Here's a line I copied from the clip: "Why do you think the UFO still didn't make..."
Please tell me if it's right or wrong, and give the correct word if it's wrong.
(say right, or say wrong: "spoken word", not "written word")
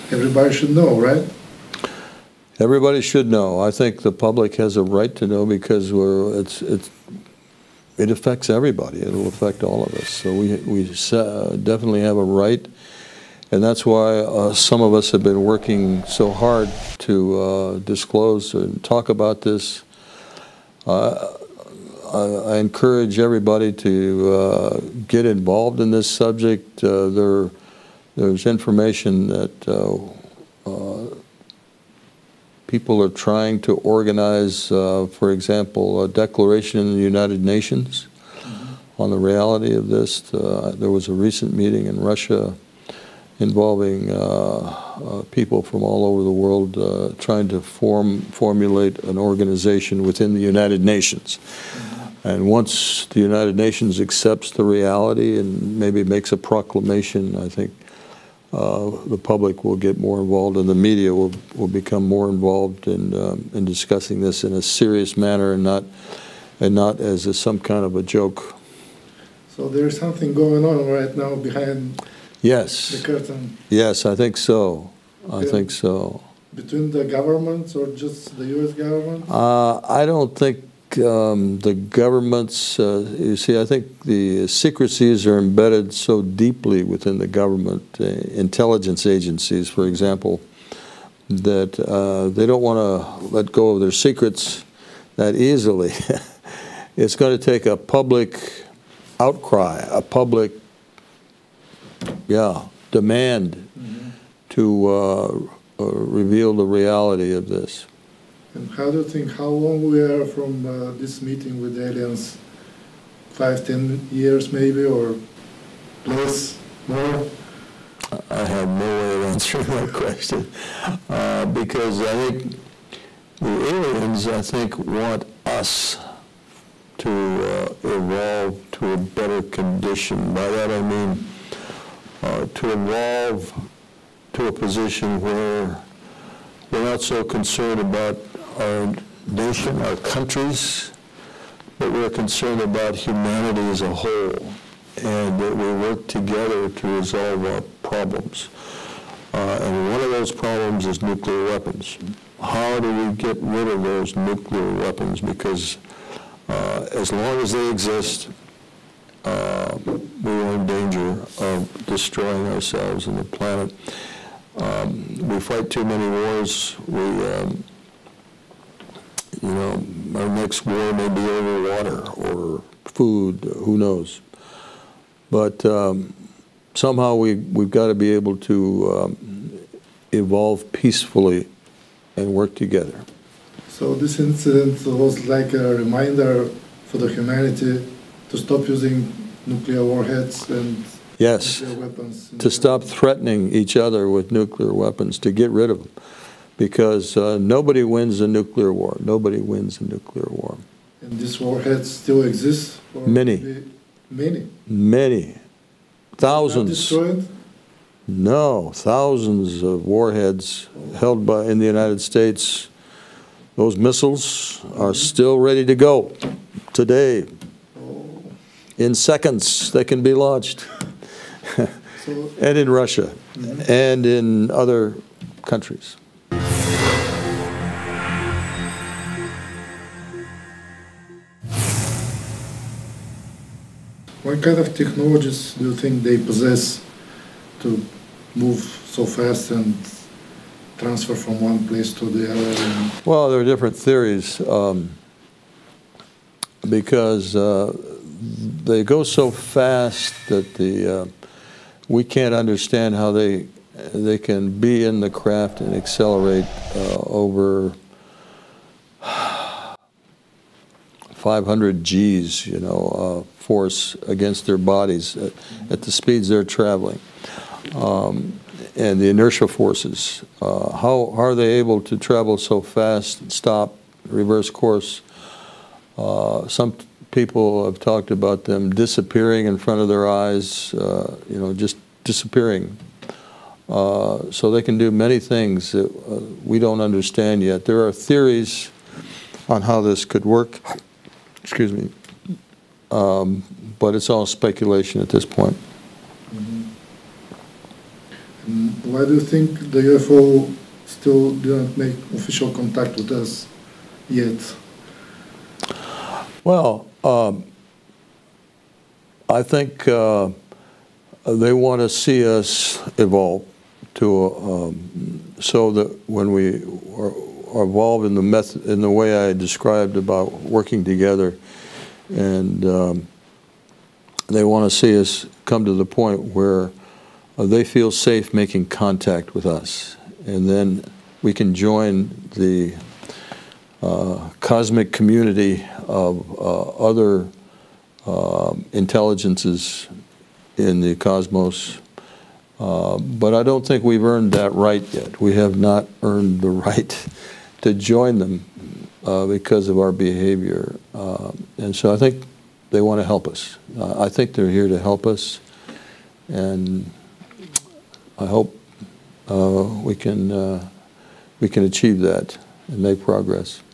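right.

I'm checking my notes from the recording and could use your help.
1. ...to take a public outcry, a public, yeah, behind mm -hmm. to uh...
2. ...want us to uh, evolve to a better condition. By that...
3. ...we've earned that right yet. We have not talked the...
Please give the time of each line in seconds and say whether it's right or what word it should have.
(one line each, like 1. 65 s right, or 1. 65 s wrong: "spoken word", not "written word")
1. 97 s wrong: "demand", not "behind"
2. 124 s right
3. 343 s wrong: "earned", not "talked".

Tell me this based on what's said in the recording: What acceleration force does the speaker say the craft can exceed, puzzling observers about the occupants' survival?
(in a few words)
500 G's.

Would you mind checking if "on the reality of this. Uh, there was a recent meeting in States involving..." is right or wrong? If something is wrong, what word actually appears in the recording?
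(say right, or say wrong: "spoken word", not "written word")
wrong: "Russia", not "States".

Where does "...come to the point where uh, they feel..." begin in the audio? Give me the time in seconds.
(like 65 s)
325 s.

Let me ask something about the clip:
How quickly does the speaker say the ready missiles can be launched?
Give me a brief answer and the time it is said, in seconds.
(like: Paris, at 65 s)
In seconds, at 218 s.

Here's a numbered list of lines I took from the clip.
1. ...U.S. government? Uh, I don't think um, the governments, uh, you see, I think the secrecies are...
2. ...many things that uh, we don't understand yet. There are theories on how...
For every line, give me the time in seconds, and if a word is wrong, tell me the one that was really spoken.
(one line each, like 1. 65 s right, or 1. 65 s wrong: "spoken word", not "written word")
1. 78 s right
2. 284 s right.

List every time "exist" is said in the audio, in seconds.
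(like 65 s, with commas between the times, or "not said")
157 s, 202 s.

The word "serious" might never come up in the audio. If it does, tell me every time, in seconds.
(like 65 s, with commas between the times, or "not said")
64 s.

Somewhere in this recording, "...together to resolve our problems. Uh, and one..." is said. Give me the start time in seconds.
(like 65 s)
146 s.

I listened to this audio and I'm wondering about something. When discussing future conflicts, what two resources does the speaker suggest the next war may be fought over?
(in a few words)
Water or food.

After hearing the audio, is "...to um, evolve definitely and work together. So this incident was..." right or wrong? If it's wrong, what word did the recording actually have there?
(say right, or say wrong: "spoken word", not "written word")
wrong: "peacefully", not "definitely".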